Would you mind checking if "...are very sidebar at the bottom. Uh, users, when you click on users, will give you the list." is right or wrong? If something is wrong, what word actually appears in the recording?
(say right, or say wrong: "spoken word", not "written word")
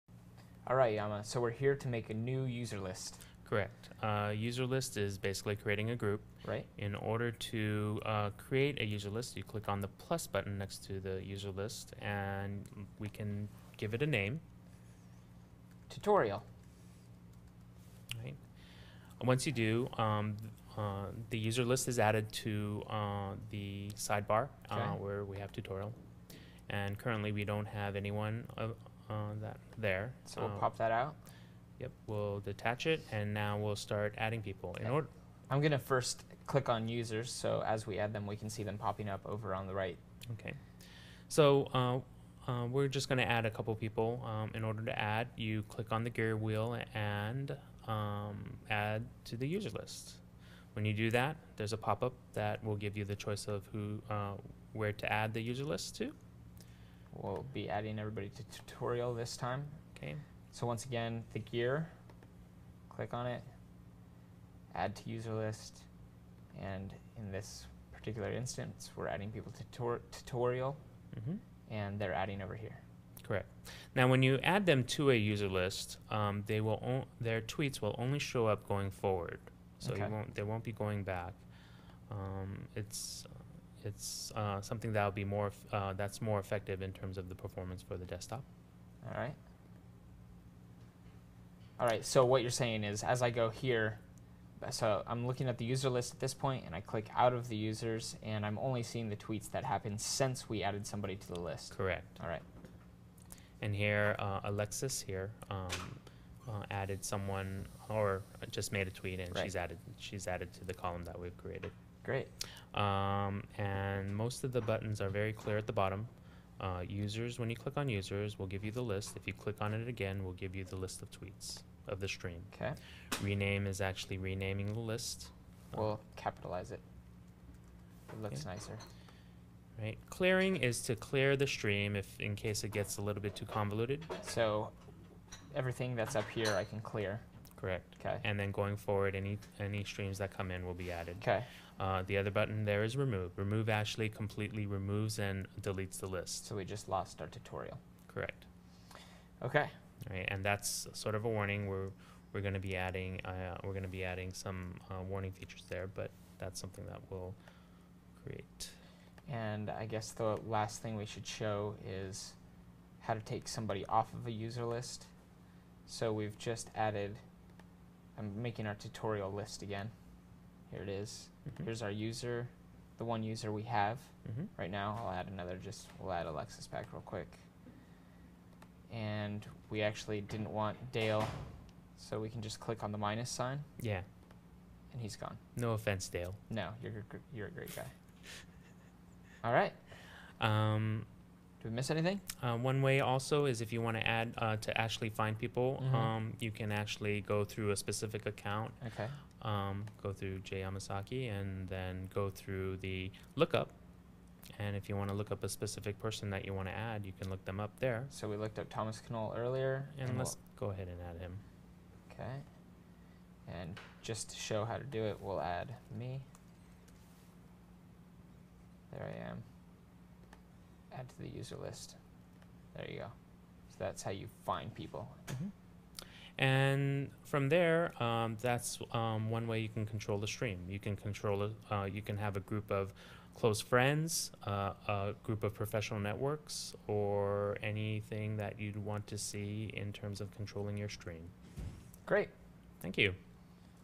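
wrong: "clear", not "sidebar".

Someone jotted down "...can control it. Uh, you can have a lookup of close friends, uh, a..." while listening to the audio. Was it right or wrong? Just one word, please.
wrong.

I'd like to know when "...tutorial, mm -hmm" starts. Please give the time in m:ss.
1:10.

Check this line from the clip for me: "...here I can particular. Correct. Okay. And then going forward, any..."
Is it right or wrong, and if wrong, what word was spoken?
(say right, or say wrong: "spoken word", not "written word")
wrong: "clear", not "particular".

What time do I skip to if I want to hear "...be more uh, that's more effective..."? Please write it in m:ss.
1:25.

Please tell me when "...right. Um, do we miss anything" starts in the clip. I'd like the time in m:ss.
3:09.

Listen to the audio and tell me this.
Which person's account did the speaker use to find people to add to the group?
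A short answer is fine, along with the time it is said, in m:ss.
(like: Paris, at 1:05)
Jay Yamasaki, at 3:20.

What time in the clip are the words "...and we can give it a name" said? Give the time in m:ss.
0:12.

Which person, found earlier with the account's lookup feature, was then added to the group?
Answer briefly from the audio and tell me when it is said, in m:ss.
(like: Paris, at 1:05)
Thomas Knoll, at 3:28.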